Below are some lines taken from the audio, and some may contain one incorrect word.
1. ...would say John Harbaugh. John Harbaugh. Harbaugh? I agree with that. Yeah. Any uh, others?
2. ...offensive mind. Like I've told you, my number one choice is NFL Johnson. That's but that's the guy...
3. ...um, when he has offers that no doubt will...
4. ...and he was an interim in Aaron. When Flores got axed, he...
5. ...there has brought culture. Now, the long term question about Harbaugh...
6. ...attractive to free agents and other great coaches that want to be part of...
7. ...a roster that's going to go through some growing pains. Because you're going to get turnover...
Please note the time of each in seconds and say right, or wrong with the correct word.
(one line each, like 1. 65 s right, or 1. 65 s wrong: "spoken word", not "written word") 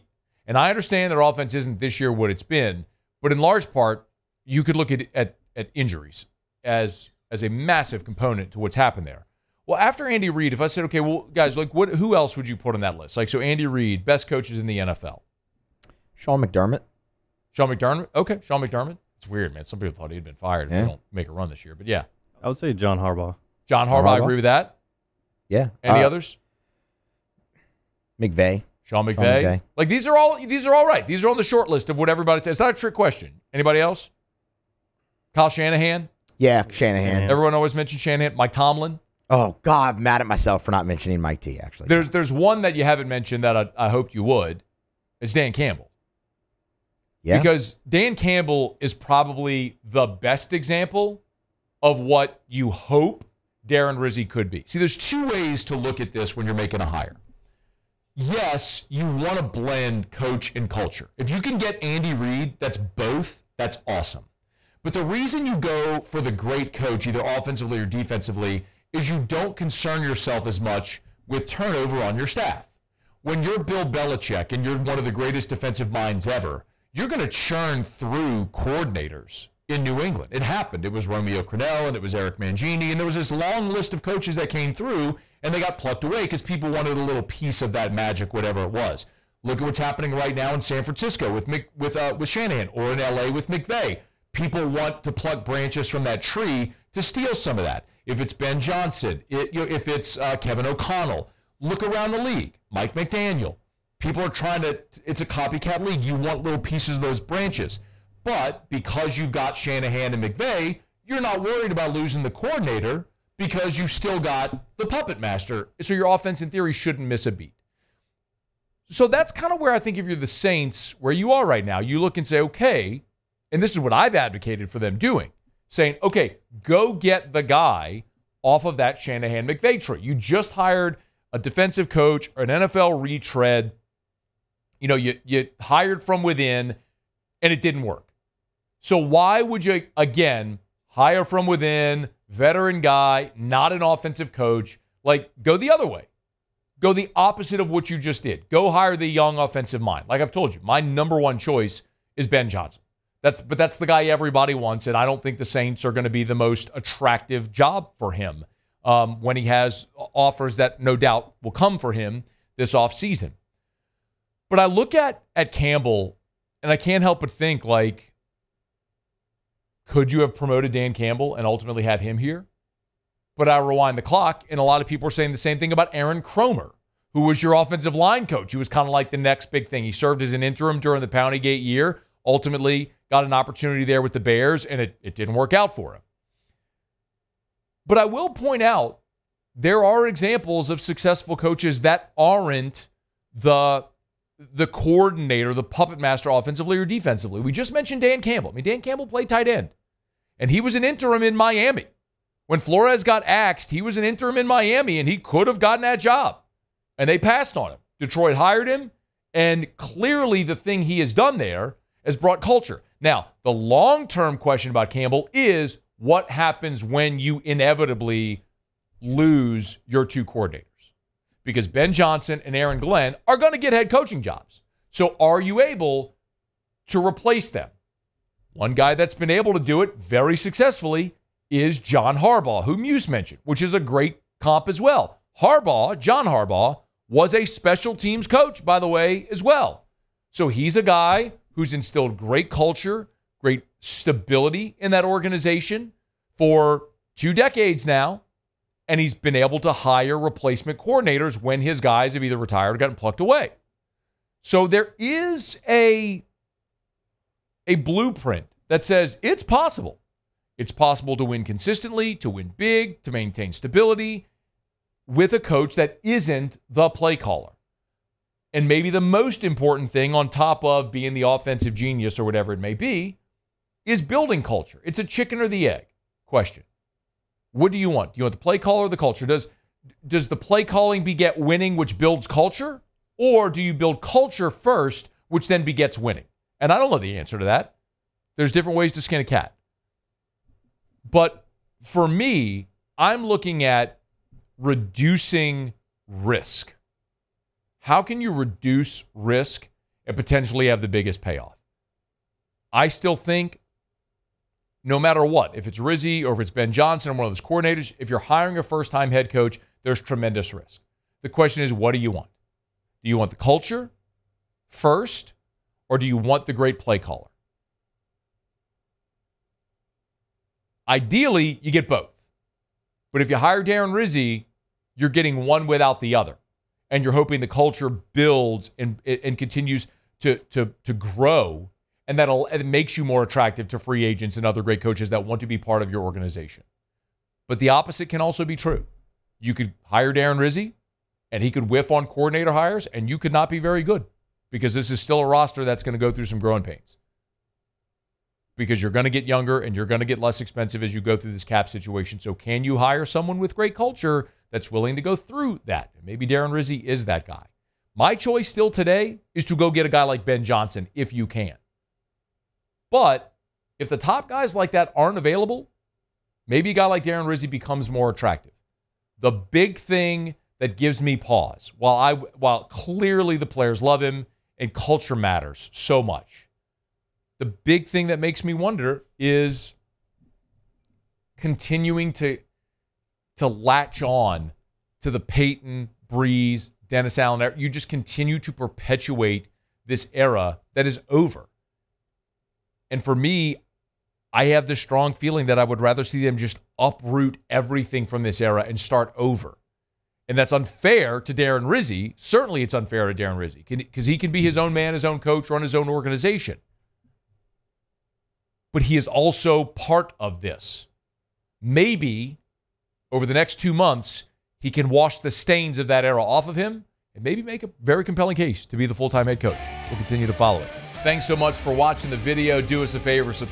1. 22 s right
2. 149 s wrong: "Ben", not "NFL"
3. 158 s right
4. 200 s wrong: "Miami", not "Aaron"
5. 211 s wrong: "Campbell", not "Harbaugh"
6. 333 s right
7. 345 s wrong: "younger", not "turnover".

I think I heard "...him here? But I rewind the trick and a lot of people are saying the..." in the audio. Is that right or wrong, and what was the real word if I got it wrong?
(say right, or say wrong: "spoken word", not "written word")
wrong: "clock", not "trick".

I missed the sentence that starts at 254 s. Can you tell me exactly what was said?
So there is a a blueprint that says it's possible.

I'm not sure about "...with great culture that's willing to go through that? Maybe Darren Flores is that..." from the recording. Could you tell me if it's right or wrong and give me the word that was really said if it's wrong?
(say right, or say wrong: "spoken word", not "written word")
wrong: "Rizzi", not "Flores".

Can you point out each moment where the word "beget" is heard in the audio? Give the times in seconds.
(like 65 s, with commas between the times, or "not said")
281 s, 285 s.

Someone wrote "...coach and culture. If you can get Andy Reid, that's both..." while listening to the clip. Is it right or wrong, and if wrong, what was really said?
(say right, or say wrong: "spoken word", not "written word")
right.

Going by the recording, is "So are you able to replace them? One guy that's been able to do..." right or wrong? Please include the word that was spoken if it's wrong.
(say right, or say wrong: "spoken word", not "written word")
right.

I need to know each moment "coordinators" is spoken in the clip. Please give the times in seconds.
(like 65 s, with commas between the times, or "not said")
78 s, 112 s, 194 s, 220 s, 250 s, 307 s, 342 s.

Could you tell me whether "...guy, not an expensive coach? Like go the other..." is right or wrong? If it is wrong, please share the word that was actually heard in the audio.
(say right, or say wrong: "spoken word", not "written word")
wrong: "offensive", not "expensive".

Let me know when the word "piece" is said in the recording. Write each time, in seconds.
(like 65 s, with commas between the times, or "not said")
87 s, 106 s.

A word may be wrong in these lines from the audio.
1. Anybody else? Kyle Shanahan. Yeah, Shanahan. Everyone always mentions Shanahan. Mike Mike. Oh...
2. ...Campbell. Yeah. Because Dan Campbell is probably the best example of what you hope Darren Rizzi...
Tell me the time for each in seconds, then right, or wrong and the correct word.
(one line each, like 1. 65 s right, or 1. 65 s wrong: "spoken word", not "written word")
1. 33 s wrong: "Tomlin", not "Mike"
2. 45 s right.